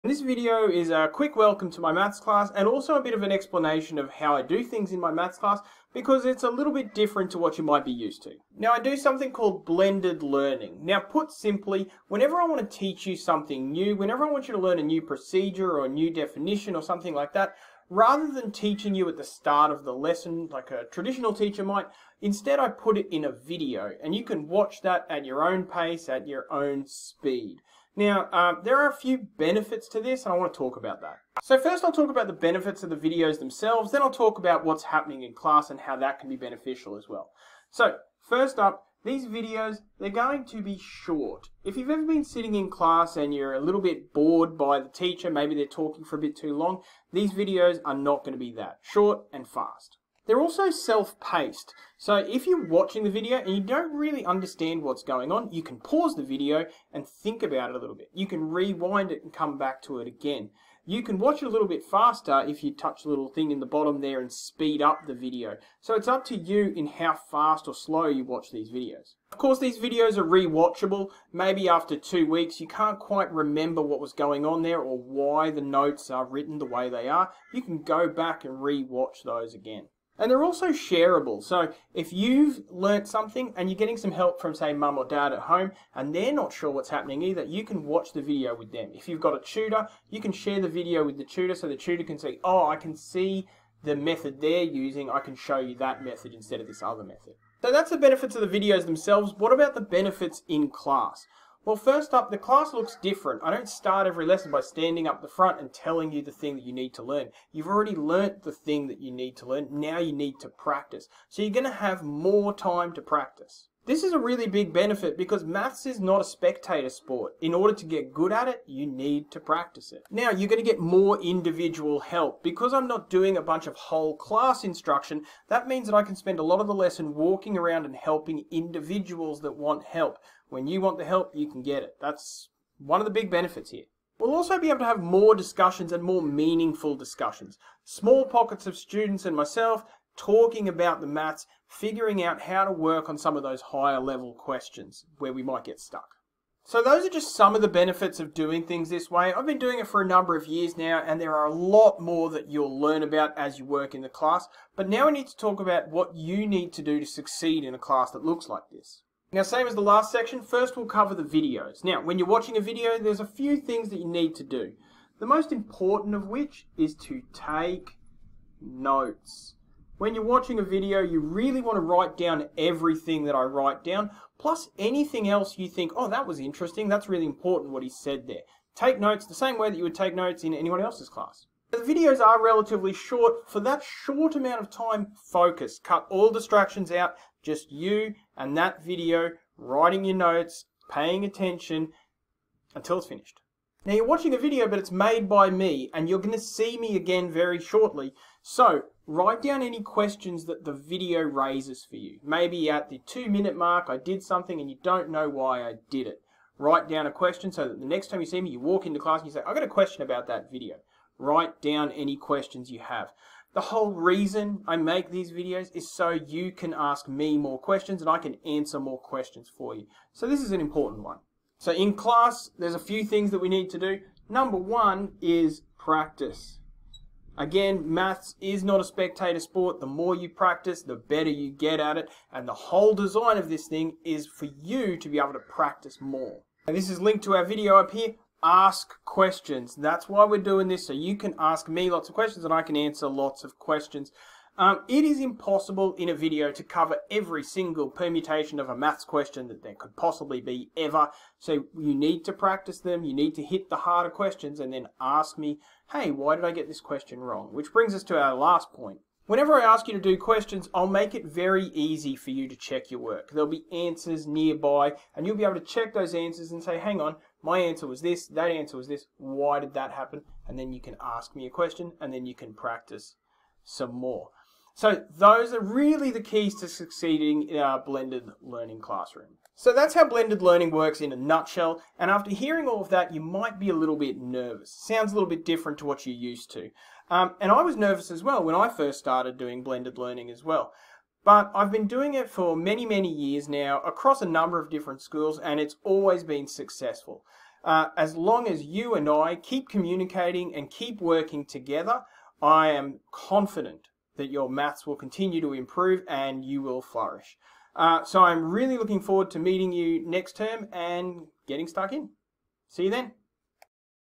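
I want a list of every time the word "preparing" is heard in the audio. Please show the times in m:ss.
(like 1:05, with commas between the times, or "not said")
not said.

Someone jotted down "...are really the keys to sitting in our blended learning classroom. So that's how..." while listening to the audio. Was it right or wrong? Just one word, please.
wrong.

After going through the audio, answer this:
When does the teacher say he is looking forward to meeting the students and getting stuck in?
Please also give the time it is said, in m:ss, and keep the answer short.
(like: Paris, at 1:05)
next term, at 5:10.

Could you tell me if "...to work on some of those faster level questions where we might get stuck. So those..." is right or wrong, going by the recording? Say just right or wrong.
wrong.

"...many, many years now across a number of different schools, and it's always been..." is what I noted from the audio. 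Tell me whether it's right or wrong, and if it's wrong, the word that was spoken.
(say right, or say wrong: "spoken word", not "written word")
right.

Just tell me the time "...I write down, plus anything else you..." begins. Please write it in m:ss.
2:53.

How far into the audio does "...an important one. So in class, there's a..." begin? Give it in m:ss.
3:40.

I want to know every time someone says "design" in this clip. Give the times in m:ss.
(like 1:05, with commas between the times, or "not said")
3:52.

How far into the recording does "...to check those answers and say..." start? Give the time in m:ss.
4:25.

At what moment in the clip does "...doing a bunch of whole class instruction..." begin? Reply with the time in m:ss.
2:03.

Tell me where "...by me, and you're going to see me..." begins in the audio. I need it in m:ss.
3:15.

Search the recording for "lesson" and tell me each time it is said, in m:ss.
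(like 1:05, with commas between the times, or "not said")
0:19, 1:44, 2:06.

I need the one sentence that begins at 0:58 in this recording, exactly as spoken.
You can rewind it and come back to it again.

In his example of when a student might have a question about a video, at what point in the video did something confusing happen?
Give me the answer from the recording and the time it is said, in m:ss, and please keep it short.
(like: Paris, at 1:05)
the two minute mark, at 3:23.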